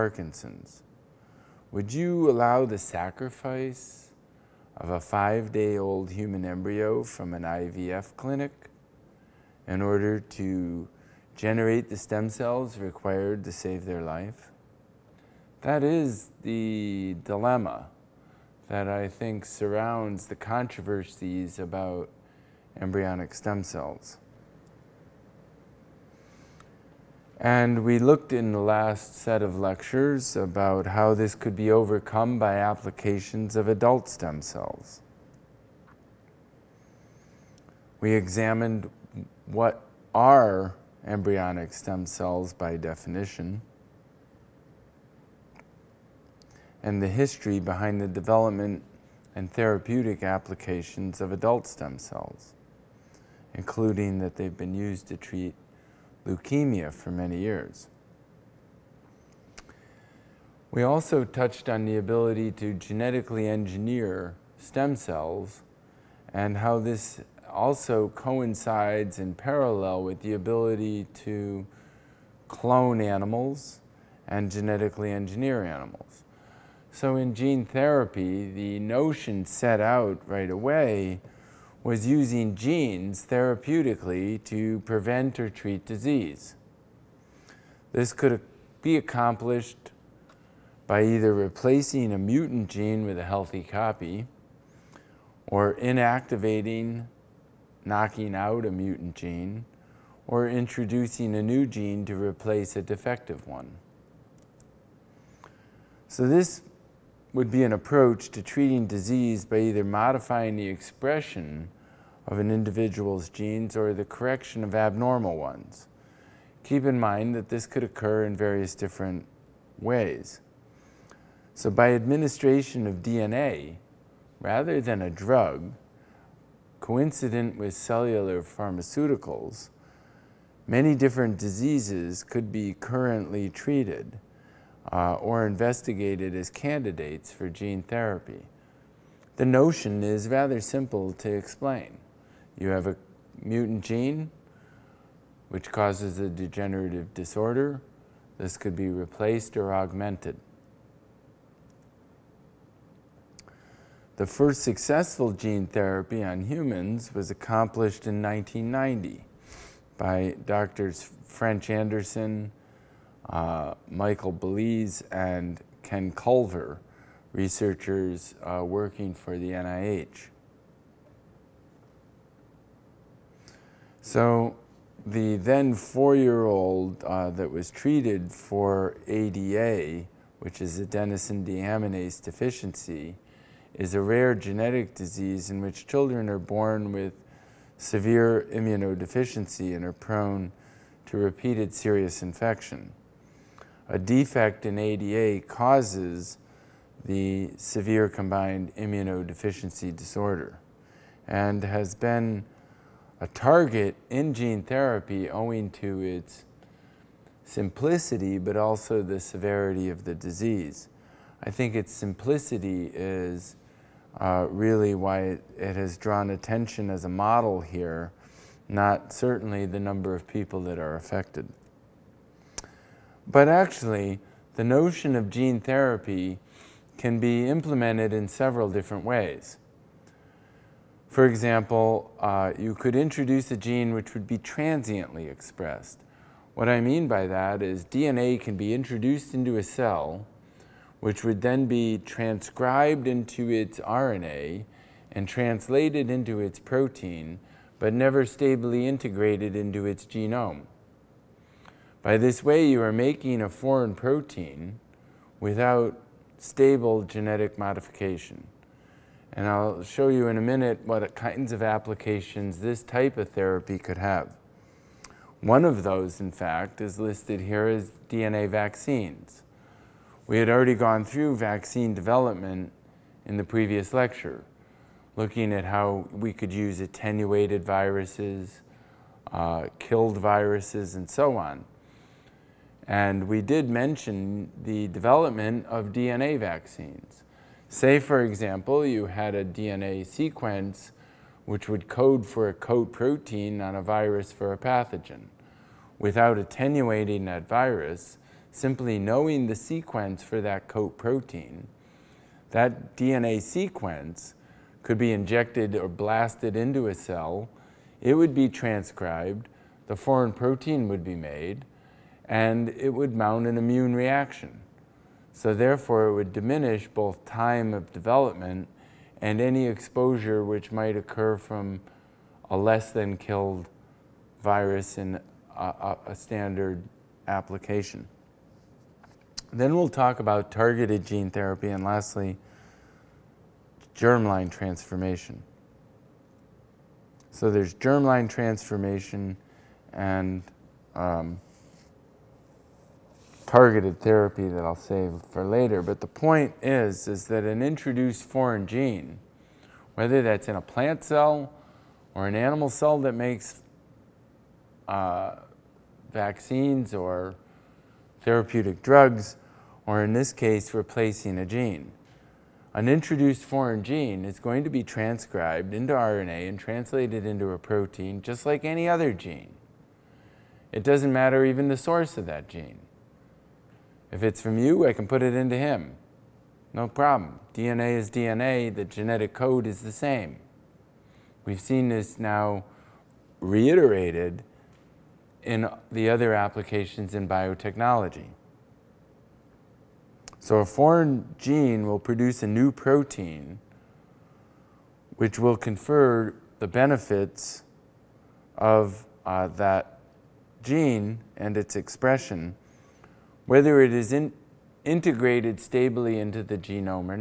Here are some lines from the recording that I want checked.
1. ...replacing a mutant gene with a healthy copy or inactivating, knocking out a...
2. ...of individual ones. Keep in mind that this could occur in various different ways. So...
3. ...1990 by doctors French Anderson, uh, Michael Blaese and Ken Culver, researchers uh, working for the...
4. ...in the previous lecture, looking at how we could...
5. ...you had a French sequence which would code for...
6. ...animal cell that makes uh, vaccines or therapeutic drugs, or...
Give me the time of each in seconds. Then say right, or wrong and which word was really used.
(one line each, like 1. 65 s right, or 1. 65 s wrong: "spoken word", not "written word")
1. 91 s right
2. 114 s wrong: "abnormal", not "individual"
3. 158 s right
4. 273 s right
5. 288 s wrong: "DNA", not "French"
6. 352 s right.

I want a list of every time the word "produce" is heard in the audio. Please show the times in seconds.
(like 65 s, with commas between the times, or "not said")
391 s.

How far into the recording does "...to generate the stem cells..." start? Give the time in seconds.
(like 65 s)
10 s.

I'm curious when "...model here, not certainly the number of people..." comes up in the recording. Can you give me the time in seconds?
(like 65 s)
217 s.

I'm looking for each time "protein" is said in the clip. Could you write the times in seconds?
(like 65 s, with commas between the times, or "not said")
246 s, 253 s, 292 s, 300 s, 310 s, 367 s, 392 s.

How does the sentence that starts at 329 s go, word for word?
Then we'll talk about targeted gene therapy and lastly, germline transformation.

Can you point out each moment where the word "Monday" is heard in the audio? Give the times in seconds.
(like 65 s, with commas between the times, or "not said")
not said.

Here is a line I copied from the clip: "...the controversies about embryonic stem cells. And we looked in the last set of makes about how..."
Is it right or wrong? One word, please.
wrong.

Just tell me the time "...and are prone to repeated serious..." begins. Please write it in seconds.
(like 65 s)
189 s.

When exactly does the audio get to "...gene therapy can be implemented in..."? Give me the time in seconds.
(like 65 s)
225 s.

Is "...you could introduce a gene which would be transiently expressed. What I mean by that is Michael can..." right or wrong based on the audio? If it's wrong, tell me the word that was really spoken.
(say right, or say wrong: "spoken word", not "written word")
wrong: "DNA", not "Michael".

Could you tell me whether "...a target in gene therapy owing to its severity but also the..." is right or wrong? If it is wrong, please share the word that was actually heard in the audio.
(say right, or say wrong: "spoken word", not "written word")
wrong: "simplicity", not "severity".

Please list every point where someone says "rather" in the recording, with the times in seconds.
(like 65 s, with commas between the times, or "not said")
124 s, 140 s.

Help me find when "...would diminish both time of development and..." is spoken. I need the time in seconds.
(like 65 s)
316 s.